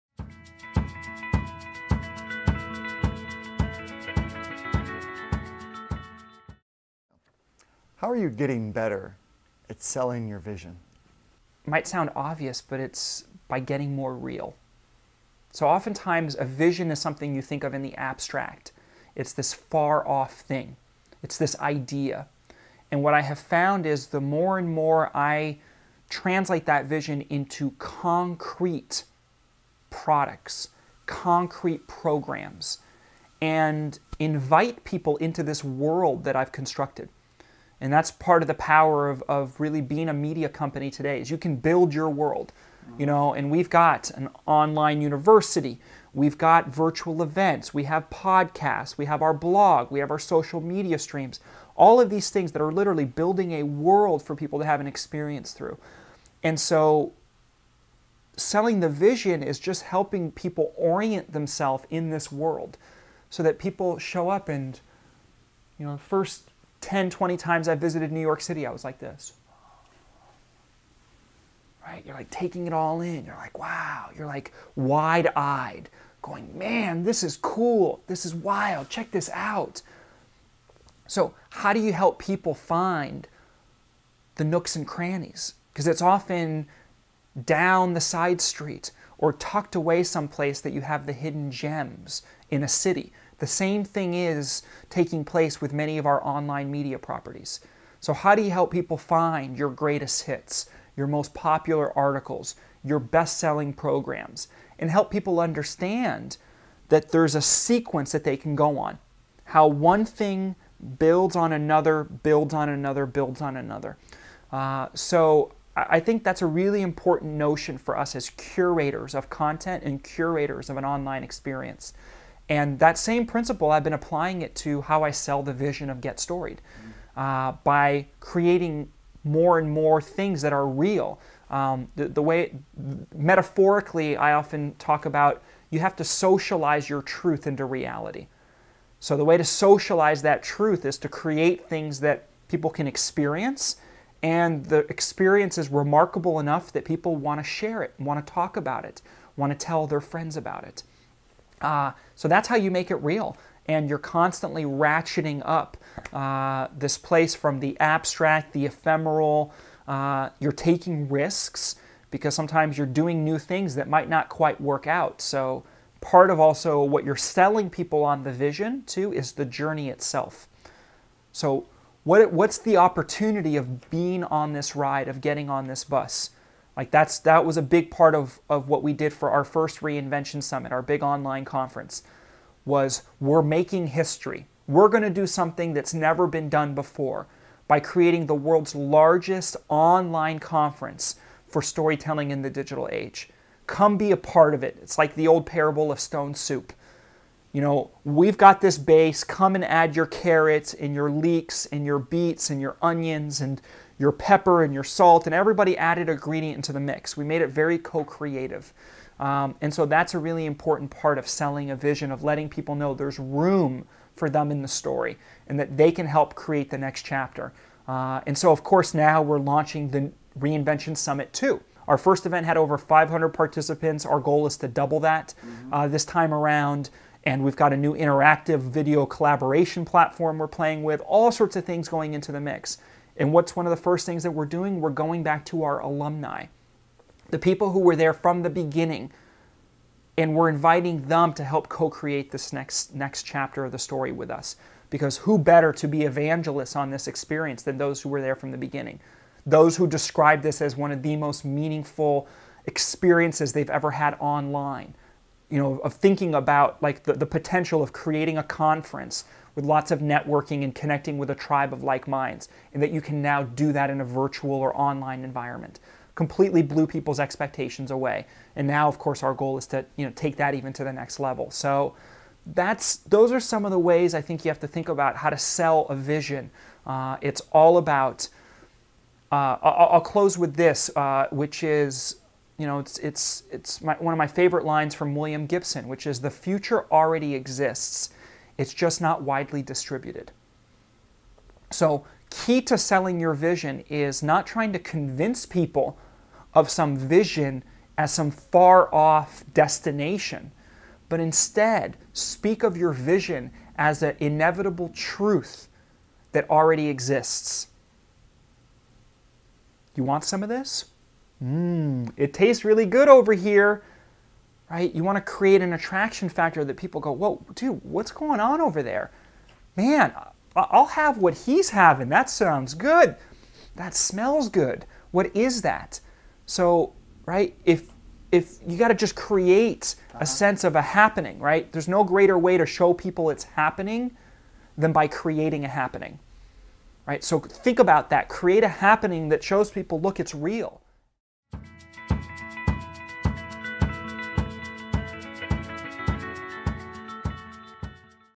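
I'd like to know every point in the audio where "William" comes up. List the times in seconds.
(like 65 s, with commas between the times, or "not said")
285 s.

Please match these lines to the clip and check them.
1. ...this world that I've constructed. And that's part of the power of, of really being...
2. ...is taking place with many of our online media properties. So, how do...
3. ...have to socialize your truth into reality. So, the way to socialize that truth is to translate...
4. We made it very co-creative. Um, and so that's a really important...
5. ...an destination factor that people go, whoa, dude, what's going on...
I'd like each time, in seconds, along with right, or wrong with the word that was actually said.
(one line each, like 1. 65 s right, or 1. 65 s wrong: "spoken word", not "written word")
1. 35 s right
2. 94 s right
3. 135 s wrong: "create", not "translate"
4. 207 s right
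5. 315 s wrong: "attraction", not "destination".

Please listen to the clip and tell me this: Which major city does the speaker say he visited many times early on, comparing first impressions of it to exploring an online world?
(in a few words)
New York City.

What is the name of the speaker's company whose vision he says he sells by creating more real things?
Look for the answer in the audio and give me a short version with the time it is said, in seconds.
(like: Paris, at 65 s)
Get Storied, at 126 s.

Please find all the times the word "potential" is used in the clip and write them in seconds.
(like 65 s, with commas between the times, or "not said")
257 s.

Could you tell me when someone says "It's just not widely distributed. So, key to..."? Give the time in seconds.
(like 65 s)
288 s.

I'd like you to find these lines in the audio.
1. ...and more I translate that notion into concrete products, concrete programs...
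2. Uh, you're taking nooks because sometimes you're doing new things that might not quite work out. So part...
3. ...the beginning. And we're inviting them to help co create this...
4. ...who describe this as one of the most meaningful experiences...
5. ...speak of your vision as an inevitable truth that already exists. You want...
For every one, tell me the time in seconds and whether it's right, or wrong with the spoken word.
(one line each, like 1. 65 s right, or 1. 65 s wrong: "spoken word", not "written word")
1. 24 s wrong: "vision", not "notion"
2. 159 s wrong: "risks", not "nooks"
3. 238 s right
4. 249 s right
5. 302 s right.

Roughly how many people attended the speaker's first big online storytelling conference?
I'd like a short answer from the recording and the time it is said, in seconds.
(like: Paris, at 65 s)
500, at 222 s.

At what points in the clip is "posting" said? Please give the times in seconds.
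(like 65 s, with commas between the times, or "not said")
not said.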